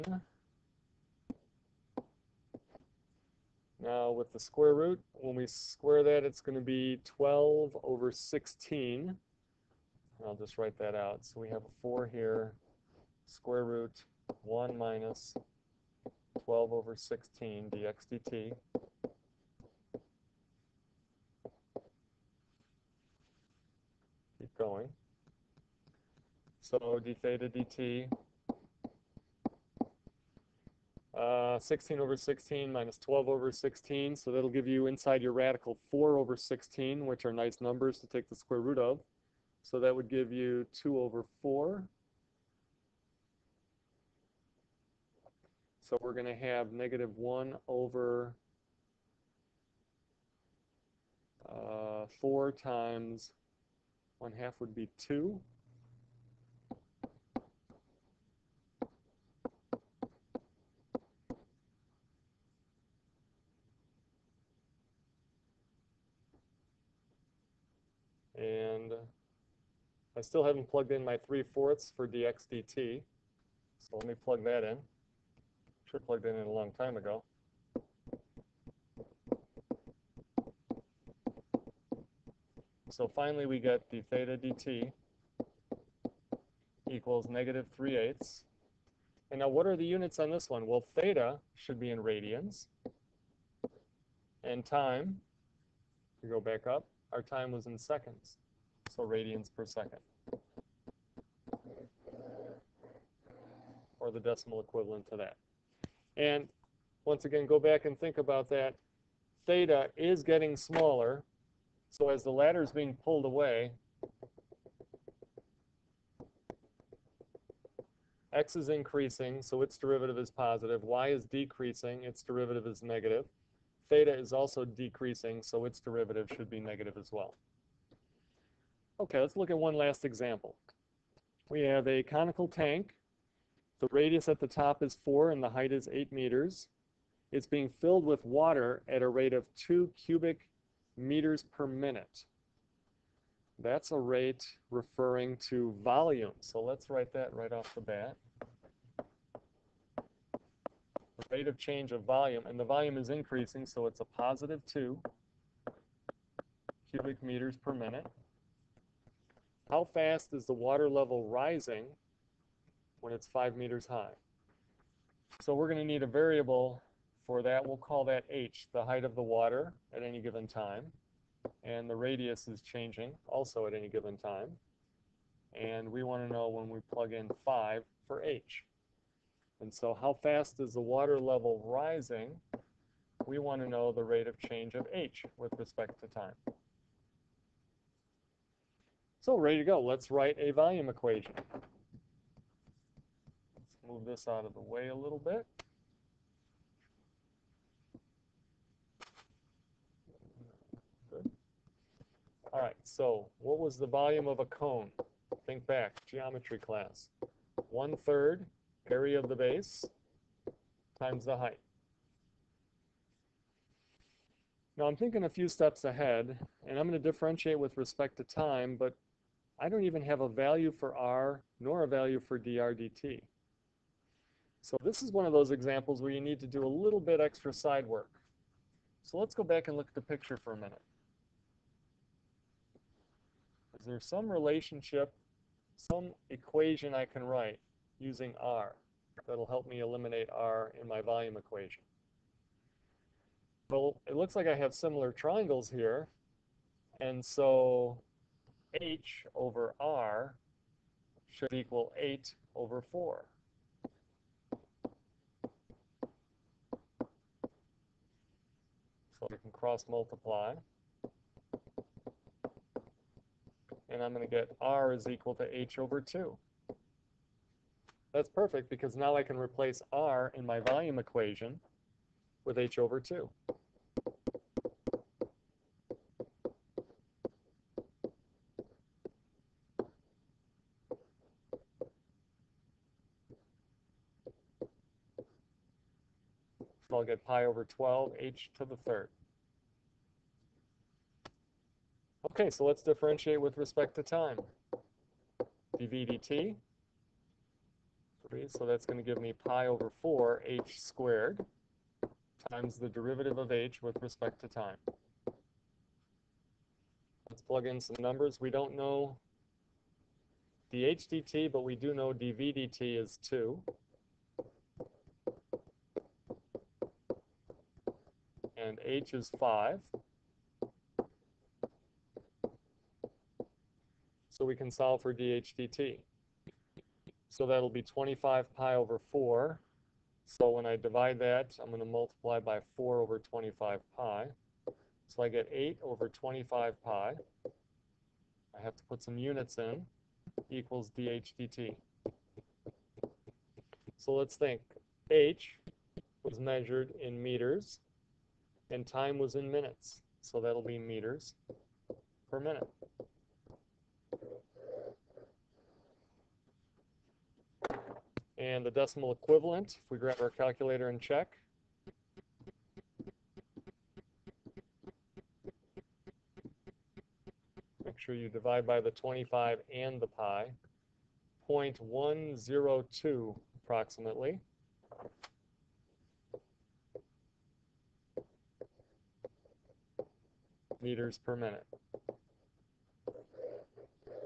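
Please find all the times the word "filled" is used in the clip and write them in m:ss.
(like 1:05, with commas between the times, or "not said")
2:17.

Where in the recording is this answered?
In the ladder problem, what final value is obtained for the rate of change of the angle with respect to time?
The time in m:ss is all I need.
1:27.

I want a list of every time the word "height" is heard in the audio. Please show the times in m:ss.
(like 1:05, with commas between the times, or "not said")
2:15, 2:48, 3:31.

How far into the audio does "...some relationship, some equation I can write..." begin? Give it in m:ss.
3:53.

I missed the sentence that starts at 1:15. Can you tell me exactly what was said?
Should have plugged in, in a long time ago.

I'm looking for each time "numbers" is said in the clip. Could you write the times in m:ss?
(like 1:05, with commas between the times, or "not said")
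0:37, 5:07.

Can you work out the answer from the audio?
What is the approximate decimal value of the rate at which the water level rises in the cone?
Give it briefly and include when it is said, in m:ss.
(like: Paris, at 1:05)
0.102, at 6:11.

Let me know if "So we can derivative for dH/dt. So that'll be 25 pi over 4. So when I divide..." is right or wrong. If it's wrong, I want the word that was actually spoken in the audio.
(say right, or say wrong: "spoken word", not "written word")
wrong: "solve", not "derivative".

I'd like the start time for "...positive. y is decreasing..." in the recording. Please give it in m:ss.
2:00.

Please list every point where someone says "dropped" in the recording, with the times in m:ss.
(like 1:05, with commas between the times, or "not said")
not said.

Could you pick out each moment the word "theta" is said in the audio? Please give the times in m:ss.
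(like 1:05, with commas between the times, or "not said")
0:27, 1:24, 1:30, 1:49, 2:03.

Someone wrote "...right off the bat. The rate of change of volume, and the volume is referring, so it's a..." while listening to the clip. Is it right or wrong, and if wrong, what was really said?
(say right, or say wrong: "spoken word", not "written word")
wrong: "increasing", not "referring".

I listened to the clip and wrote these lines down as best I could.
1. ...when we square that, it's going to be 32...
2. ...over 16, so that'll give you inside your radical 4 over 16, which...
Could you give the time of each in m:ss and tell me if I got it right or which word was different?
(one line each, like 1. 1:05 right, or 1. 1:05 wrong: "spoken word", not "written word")
1. 0:05 wrong: "12", not "32"
2. 0:33 right.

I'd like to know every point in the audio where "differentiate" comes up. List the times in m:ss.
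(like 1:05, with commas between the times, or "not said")
3:37, 4:52.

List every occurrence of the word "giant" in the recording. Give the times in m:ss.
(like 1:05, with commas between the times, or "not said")
not said.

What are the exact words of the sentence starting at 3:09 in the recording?
Let's write a volume equation move this out of the way a little bit.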